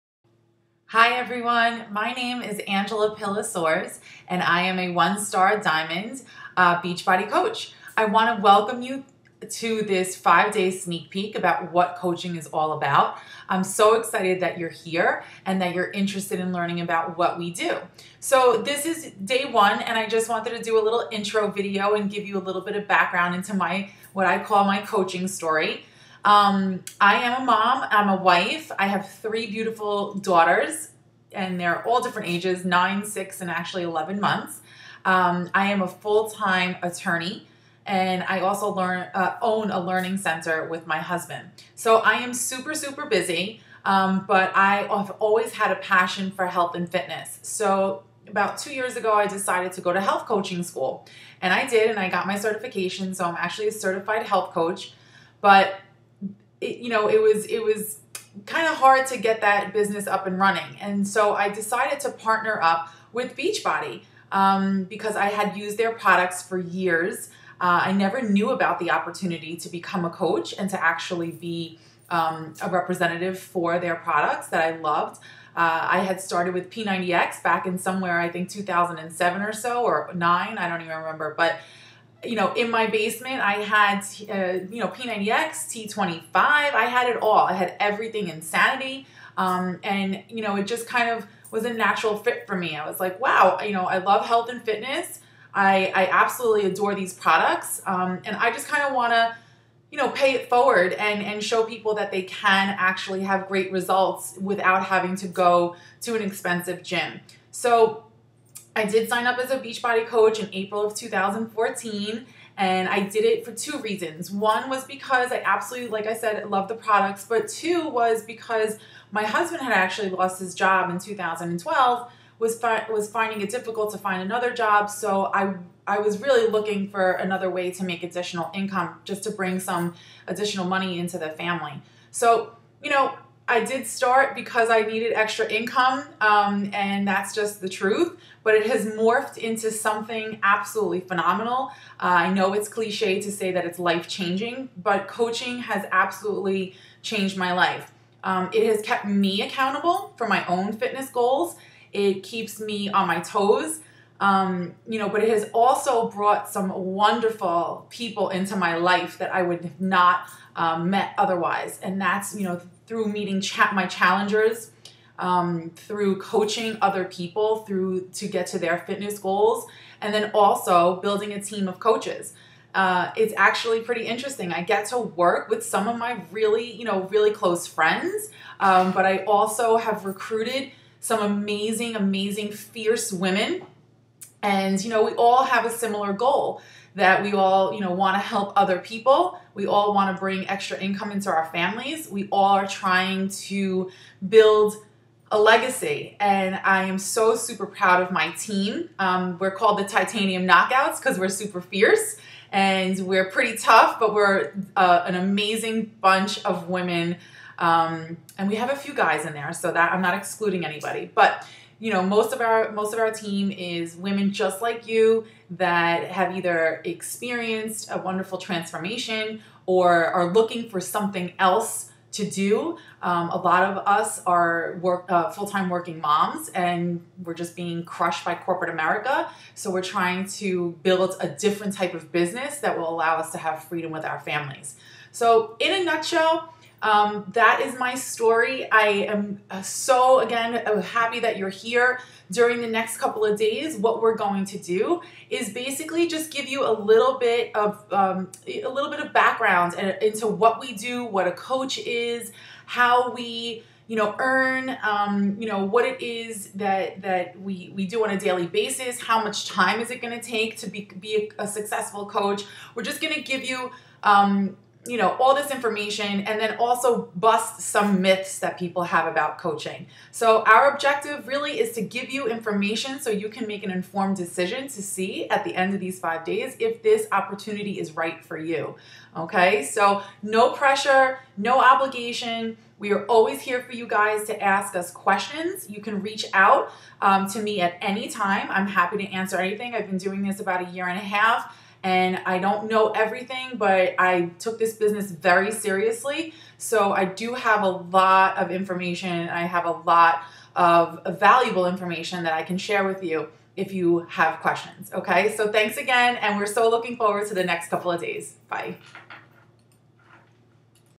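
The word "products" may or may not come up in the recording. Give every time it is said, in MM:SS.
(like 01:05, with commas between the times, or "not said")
01:05, 01:13, 01:37, 01:56.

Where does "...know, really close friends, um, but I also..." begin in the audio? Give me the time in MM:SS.
02:56.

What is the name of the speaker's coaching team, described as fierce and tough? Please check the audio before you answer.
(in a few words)
Titanium Knockouts.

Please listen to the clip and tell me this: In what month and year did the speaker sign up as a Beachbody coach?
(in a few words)
April 2014.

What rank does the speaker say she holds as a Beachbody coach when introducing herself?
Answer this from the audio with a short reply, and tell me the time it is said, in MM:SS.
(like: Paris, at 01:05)
One star diamond, at 00:04.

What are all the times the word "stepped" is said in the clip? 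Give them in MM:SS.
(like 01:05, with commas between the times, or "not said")
not said.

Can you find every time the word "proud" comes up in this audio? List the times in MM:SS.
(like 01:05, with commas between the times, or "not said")
03:17.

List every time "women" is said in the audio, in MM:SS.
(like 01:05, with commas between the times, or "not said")
03:03, 03:26, 03:33.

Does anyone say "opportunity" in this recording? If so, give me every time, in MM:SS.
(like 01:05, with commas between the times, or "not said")
01:08, 04:37.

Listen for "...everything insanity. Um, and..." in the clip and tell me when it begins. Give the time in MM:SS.
01:27.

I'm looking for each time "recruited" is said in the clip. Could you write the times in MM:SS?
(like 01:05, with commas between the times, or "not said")
03:00.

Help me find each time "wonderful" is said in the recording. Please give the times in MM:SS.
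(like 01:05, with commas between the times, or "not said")
02:36, 03:37.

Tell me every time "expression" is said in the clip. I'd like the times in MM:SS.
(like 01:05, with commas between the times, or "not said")
not said.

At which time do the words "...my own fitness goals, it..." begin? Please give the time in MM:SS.
02:30.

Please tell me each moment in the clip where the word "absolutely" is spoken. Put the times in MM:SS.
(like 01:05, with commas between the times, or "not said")
01:36, 01:55, 02:20, 02:25.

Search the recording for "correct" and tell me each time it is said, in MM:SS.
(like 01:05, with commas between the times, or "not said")
not said.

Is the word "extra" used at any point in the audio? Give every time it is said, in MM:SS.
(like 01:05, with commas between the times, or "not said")
02:15, 03:10.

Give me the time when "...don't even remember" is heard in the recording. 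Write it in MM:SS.
01:20.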